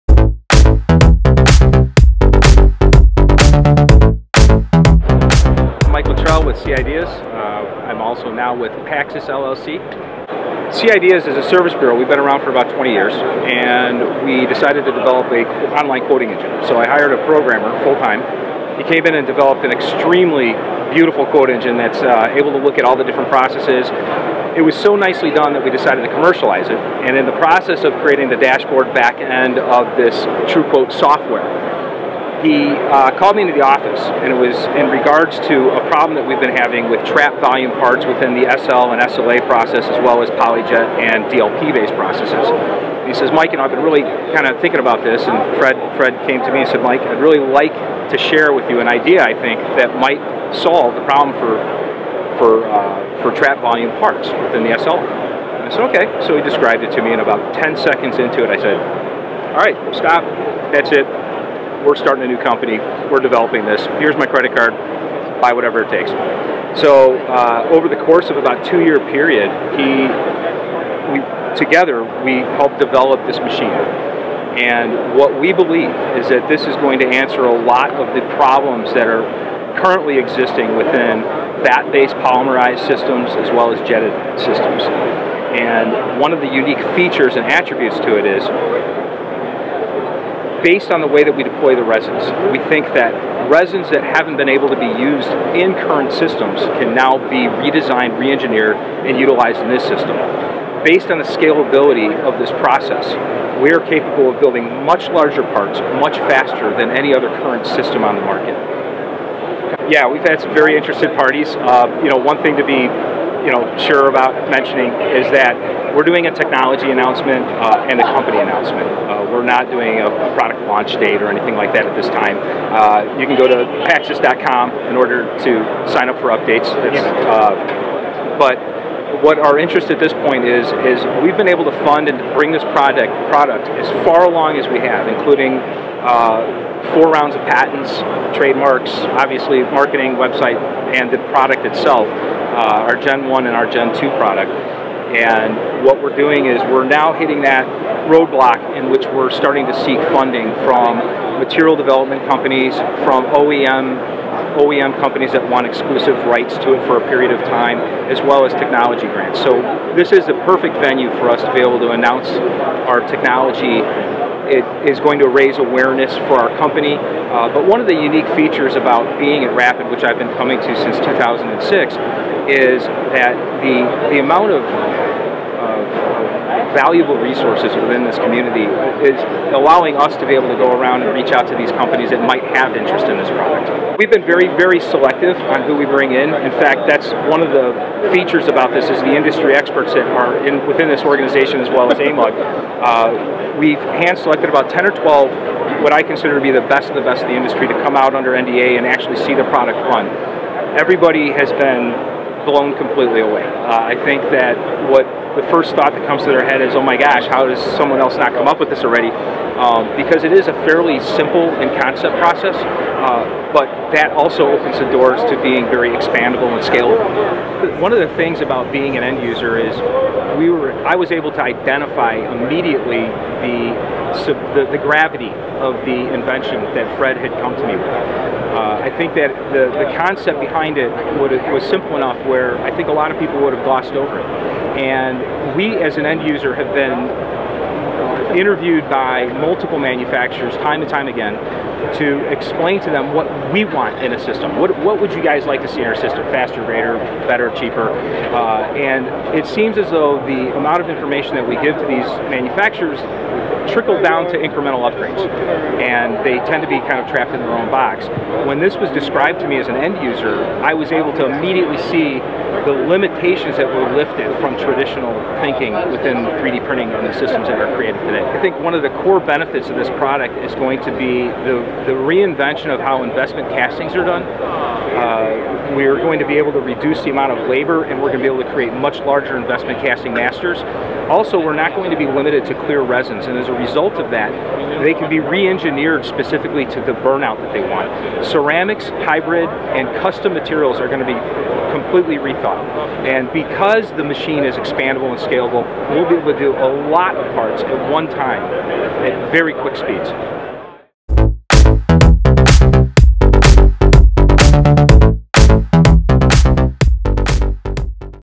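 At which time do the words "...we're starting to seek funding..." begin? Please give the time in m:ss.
2:29.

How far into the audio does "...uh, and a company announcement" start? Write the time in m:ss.
1:57.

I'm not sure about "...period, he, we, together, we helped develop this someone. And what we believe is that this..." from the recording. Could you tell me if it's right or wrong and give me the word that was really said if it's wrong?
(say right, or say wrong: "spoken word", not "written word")
wrong: "machine", not "someone".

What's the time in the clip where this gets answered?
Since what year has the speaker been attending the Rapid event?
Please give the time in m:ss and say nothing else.
2:50.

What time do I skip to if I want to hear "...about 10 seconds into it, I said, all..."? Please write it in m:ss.
0:57.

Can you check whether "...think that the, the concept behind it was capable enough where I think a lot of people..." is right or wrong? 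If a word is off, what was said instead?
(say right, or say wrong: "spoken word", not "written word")
wrong: "simple", not "capable".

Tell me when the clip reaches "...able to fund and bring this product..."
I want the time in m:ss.
2:11.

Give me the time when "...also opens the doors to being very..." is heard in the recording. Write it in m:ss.
3:34.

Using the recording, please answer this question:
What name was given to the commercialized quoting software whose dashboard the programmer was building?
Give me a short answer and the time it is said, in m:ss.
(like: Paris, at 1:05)
TrueQuote, at 0:30.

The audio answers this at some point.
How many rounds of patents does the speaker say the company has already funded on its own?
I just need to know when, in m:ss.
2:16.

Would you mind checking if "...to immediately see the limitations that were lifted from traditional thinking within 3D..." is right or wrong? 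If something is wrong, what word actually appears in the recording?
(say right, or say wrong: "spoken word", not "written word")
right.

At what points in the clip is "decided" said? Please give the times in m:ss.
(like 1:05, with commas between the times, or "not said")
0:14, 0:25.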